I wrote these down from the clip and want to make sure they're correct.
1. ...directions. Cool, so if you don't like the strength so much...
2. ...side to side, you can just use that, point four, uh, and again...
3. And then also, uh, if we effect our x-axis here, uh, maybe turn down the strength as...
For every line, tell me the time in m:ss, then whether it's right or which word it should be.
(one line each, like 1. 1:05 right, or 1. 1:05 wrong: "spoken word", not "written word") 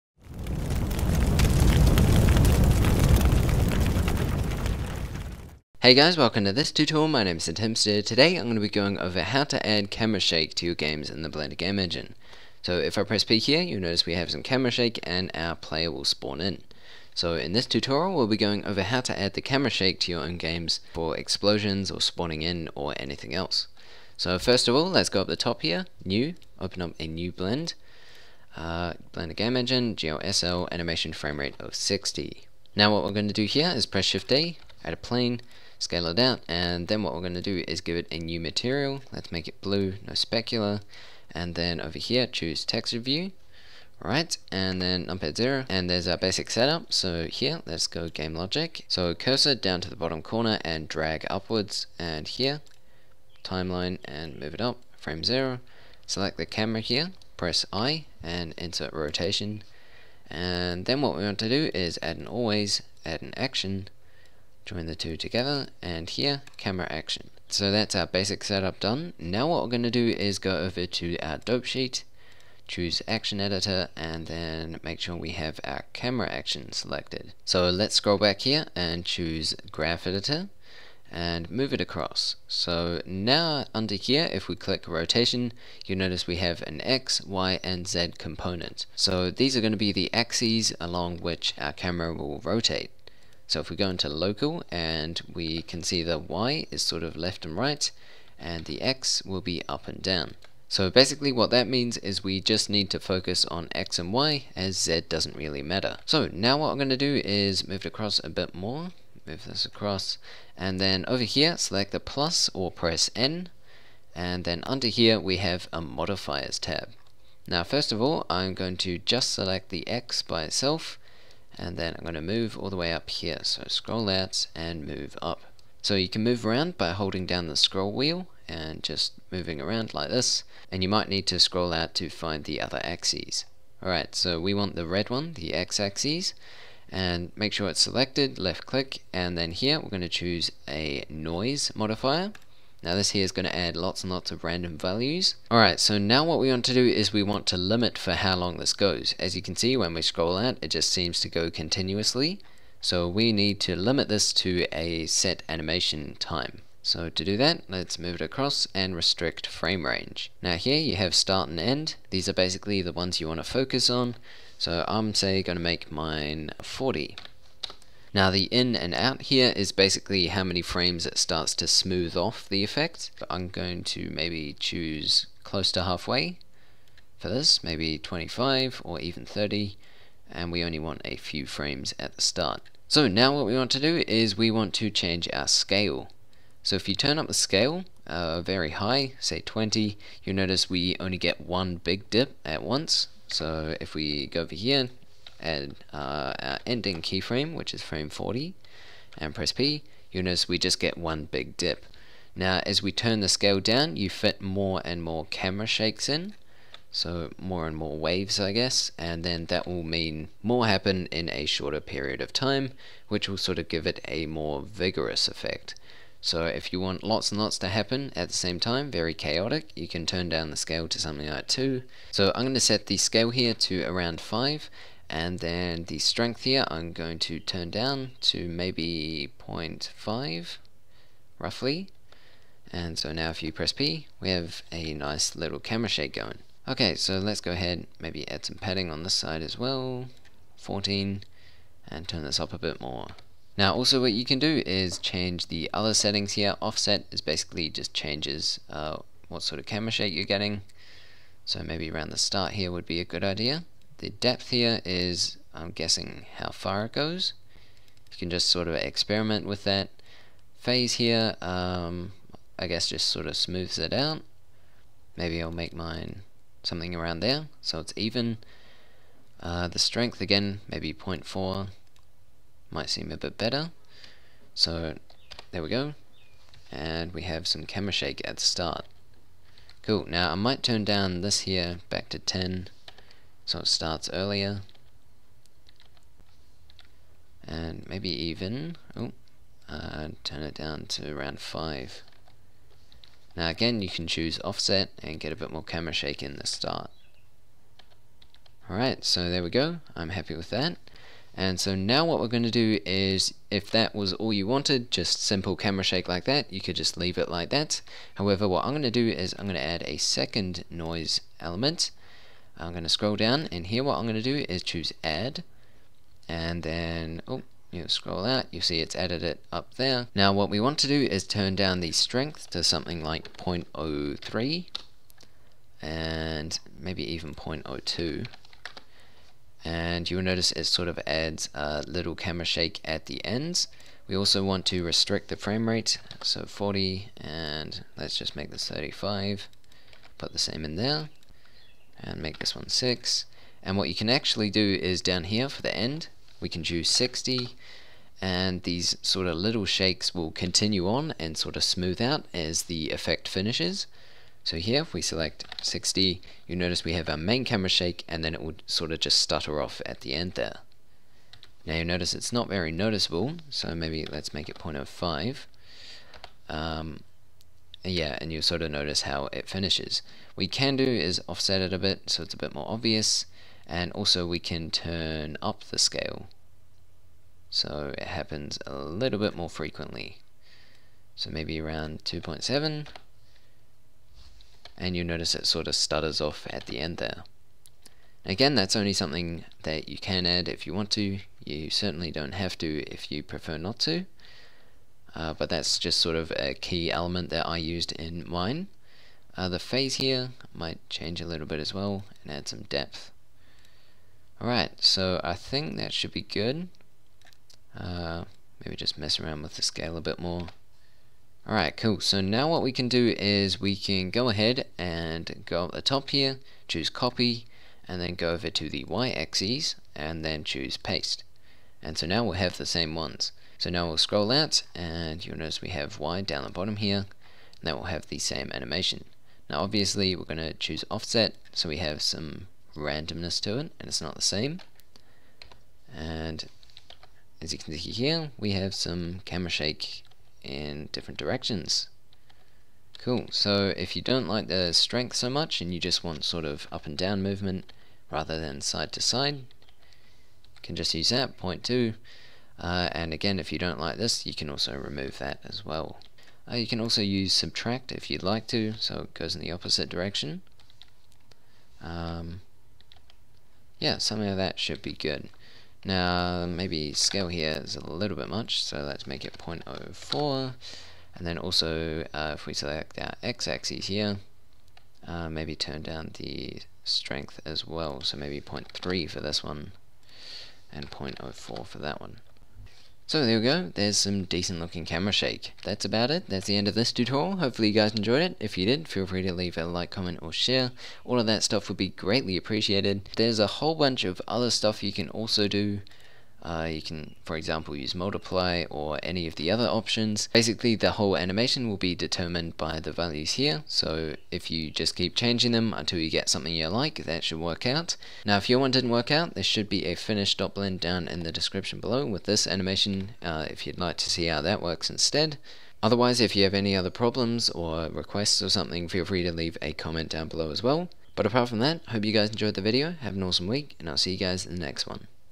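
1. 7:21 right
2. 7:28 wrong: "two", not "four"
3. 7:51 wrong: "select", not "effect".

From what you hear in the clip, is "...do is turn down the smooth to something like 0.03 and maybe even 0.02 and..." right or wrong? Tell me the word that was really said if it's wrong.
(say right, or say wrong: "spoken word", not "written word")
wrong: "strength", not "smooth".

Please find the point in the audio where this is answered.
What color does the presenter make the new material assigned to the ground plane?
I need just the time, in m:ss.
0:39.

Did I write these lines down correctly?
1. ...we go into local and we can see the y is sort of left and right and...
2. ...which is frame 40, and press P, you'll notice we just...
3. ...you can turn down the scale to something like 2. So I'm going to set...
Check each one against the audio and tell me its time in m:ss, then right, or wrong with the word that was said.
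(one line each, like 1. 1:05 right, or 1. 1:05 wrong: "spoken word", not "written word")
1. 1:33 right
2. 3:17 right
3. 3:39 right.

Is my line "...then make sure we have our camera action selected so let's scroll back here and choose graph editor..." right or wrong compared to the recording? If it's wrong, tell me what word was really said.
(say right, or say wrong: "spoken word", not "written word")
right.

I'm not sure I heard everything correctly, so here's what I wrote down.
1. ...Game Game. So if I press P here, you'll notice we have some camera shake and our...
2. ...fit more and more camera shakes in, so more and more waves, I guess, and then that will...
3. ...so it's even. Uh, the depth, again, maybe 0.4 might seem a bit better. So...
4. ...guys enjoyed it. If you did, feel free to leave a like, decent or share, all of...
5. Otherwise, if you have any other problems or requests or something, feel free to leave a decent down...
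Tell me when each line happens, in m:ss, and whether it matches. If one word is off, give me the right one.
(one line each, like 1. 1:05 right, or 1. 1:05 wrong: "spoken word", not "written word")
1. 0:11 wrong: "Engine", not "Game"
2. 3:24 right
3. 4:27 wrong: "strength", not "depth"
4. 8:07 wrong: "comment", not "decent"
5. 8:35 wrong: "comment", not "decent".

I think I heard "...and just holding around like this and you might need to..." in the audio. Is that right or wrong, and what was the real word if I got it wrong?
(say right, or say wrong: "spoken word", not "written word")
wrong: "moving", not "holding".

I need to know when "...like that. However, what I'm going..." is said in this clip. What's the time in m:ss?
5:07.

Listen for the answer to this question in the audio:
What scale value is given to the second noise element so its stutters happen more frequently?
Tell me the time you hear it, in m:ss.
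6:22.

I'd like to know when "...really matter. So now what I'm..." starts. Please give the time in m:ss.
1:45.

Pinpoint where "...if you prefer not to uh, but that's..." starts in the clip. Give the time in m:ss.
6:32.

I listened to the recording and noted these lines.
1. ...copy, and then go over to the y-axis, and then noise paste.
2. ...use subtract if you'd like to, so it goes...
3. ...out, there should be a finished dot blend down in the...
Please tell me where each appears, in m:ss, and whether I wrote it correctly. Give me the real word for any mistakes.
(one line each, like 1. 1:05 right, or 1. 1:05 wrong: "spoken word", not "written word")
1. 6:56 wrong: "choose", not "noise"
2. 7:37 right
3. 8:29 right.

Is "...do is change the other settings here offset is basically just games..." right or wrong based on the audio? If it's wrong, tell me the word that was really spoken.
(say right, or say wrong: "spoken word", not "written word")
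wrong: "changes", not "games".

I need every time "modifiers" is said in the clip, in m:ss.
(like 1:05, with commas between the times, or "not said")
1:55, 2:21.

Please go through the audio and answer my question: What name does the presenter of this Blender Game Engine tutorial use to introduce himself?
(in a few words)
Timster.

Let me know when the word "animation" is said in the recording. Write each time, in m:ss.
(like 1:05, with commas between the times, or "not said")
0:30, 2:35, 7:08, 8:21, 8:32.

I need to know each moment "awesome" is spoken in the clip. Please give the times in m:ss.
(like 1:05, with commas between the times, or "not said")
8:43.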